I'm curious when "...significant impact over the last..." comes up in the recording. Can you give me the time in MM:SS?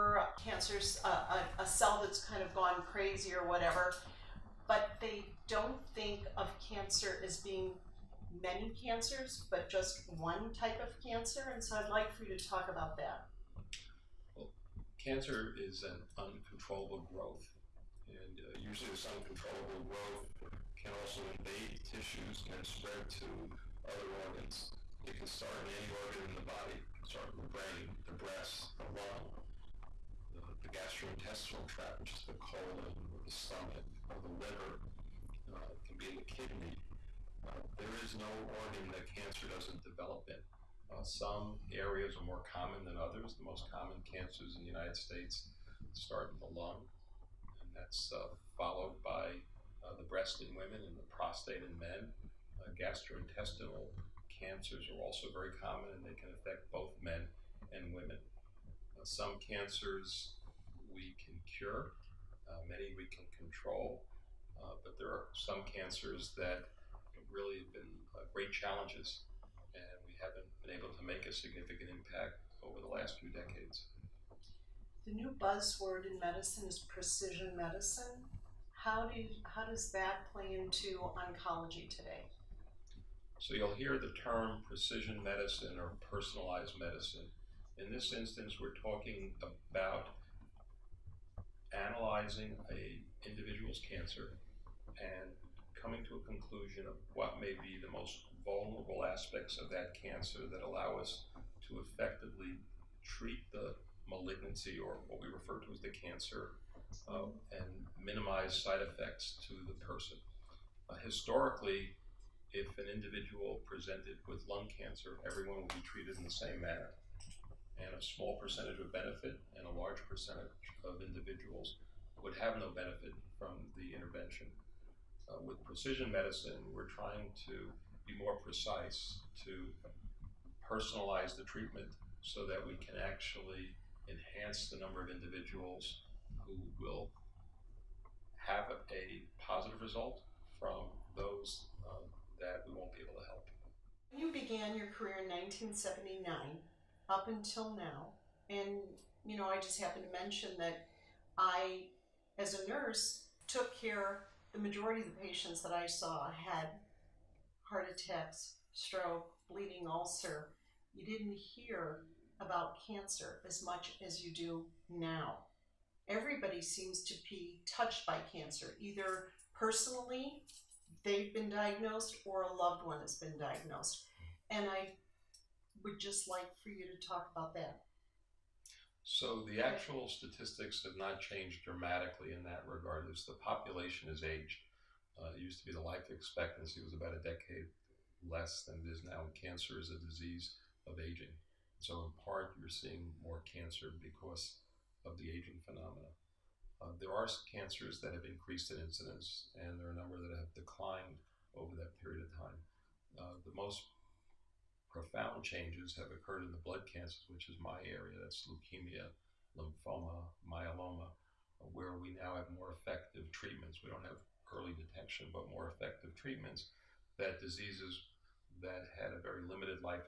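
01:11.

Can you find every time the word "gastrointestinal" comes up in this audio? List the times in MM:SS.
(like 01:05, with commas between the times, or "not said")
00:30, 00:52.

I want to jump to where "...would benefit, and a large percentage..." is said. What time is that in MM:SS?
01:58.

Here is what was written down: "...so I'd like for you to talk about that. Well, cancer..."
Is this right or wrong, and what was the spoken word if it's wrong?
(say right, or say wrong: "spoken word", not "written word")
right.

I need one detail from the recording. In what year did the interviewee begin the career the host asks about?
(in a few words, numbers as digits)
1979.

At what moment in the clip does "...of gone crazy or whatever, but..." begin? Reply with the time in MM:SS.
00:02.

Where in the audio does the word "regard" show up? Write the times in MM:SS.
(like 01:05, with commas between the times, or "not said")
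03:02.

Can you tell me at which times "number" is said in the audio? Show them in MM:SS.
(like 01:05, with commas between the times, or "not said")
02:14, 03:19.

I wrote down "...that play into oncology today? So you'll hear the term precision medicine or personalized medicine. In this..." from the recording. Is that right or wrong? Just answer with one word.
right.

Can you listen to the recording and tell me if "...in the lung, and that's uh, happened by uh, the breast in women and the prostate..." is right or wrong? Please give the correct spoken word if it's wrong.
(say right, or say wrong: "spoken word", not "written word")
wrong: "followed", not "happened".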